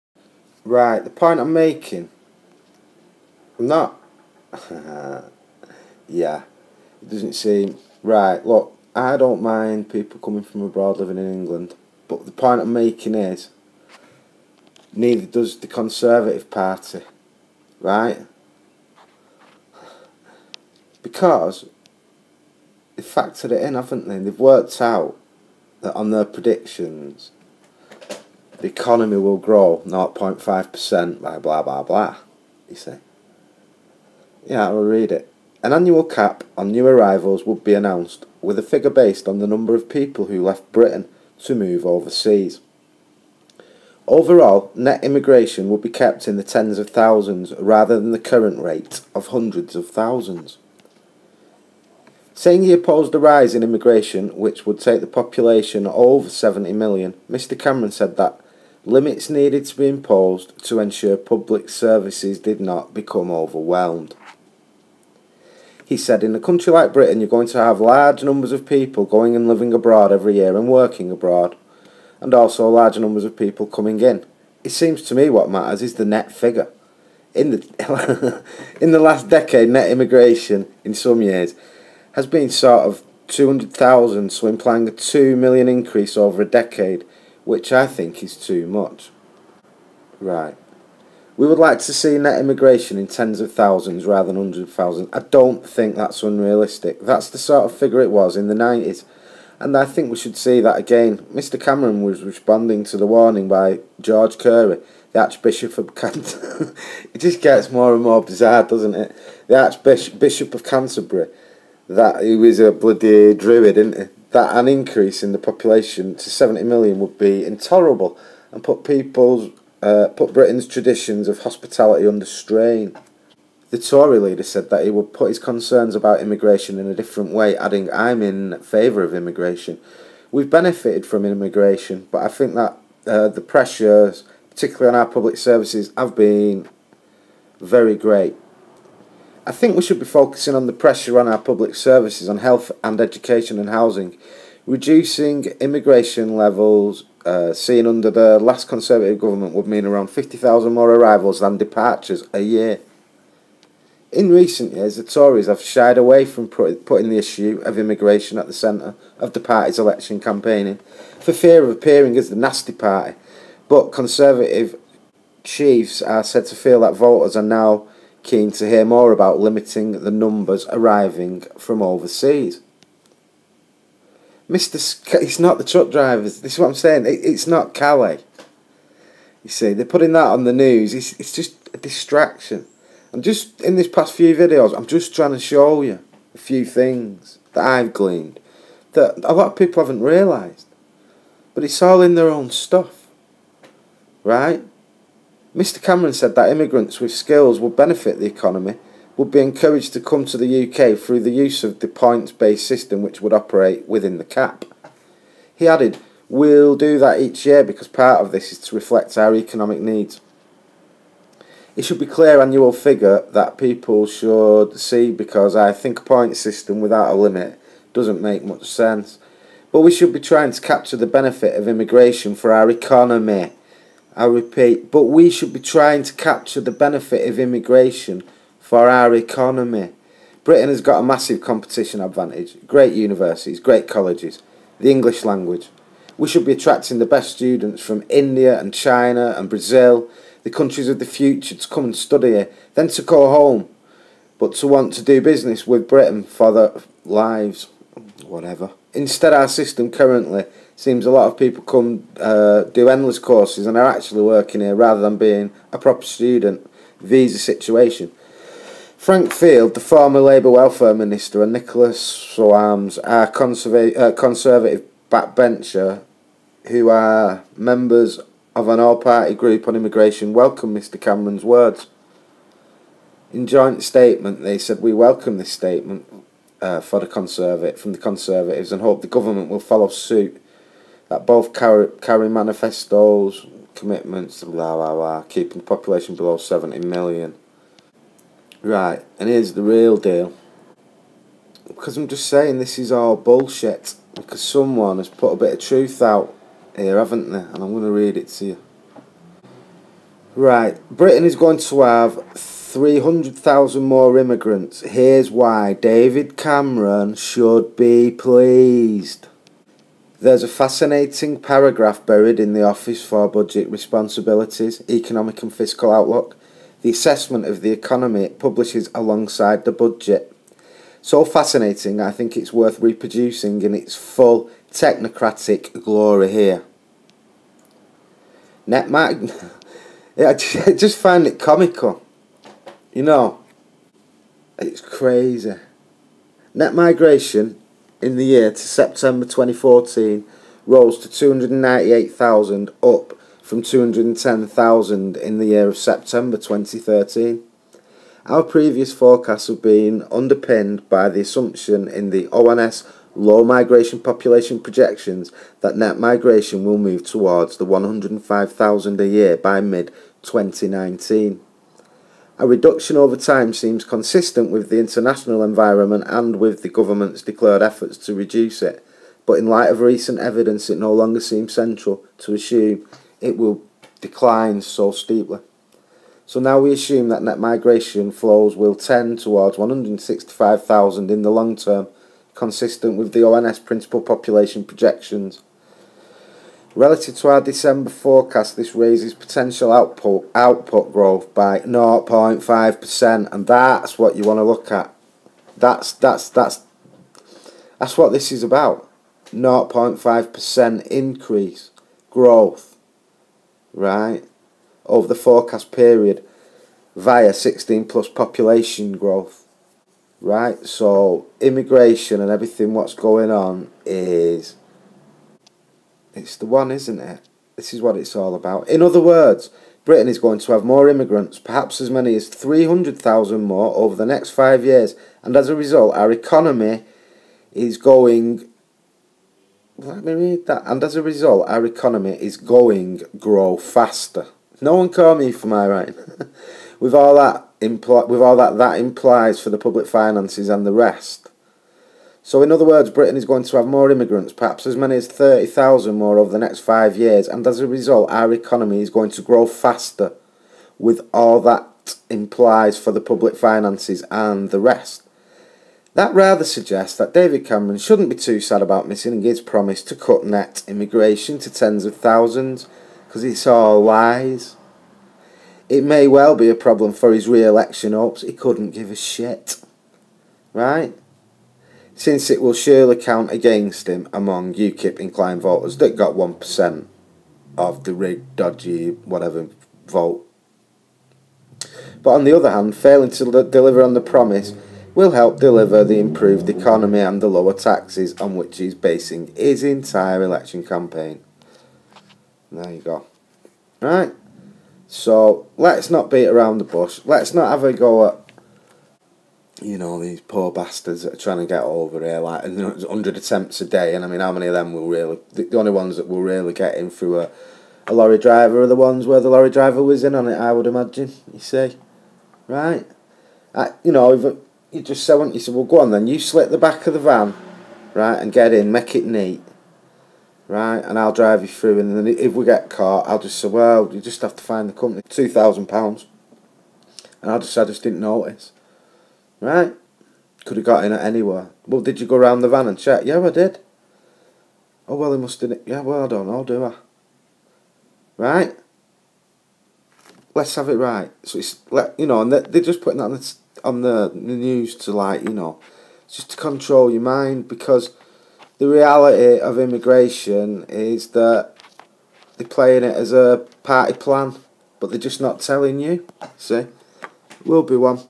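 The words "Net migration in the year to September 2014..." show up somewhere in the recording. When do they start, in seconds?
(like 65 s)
336 s.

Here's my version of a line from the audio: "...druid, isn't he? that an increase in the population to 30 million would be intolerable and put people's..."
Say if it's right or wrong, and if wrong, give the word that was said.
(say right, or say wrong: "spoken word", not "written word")
wrong: "70", not "30".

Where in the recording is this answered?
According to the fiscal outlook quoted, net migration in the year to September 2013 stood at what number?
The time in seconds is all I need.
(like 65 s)
343 s.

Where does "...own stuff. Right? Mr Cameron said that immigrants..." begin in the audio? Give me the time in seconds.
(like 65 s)
192 s.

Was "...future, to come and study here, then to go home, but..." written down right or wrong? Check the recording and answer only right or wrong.
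right.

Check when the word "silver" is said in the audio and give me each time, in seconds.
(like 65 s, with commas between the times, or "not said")
not said.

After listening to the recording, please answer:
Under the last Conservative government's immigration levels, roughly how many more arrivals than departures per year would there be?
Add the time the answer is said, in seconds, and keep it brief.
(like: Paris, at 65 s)
50,000, at 150 s.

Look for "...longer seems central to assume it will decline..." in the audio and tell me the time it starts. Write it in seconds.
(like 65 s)
370 s.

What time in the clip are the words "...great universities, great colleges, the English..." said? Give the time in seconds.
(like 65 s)
232 s.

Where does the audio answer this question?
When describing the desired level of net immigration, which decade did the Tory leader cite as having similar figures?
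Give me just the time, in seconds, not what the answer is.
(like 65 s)
98 s.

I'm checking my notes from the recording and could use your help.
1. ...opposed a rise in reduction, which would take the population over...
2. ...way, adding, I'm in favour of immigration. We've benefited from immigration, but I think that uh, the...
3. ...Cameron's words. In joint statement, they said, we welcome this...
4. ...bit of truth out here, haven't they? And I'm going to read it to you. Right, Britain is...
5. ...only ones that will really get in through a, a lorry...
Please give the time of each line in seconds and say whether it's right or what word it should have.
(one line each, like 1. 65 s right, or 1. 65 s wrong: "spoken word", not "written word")
1. 52 s wrong: "immigration", not "reduction"
2. 127 s right
3. 271 s right
4. 295 s right
5. 505 s right.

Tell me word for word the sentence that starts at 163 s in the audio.
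But Conservative chiefs are said to feel that voters are now keen to hear more about limiting the numbers arriving from overseas.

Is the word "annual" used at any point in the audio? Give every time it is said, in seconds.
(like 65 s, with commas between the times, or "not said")
35 s, 212 s.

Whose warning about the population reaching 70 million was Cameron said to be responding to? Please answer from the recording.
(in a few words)
George Carey.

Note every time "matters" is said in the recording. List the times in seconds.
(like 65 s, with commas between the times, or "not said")
75 s.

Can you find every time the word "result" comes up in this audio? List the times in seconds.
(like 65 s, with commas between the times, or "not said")
425 s, 431 s, 447 s.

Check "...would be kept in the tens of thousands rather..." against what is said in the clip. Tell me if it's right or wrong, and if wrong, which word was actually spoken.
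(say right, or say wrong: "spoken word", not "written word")
right.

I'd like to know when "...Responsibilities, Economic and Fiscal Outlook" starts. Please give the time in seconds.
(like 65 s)
313 s.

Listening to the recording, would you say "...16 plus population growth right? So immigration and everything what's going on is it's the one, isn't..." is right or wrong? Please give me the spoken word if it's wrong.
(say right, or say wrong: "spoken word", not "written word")
right.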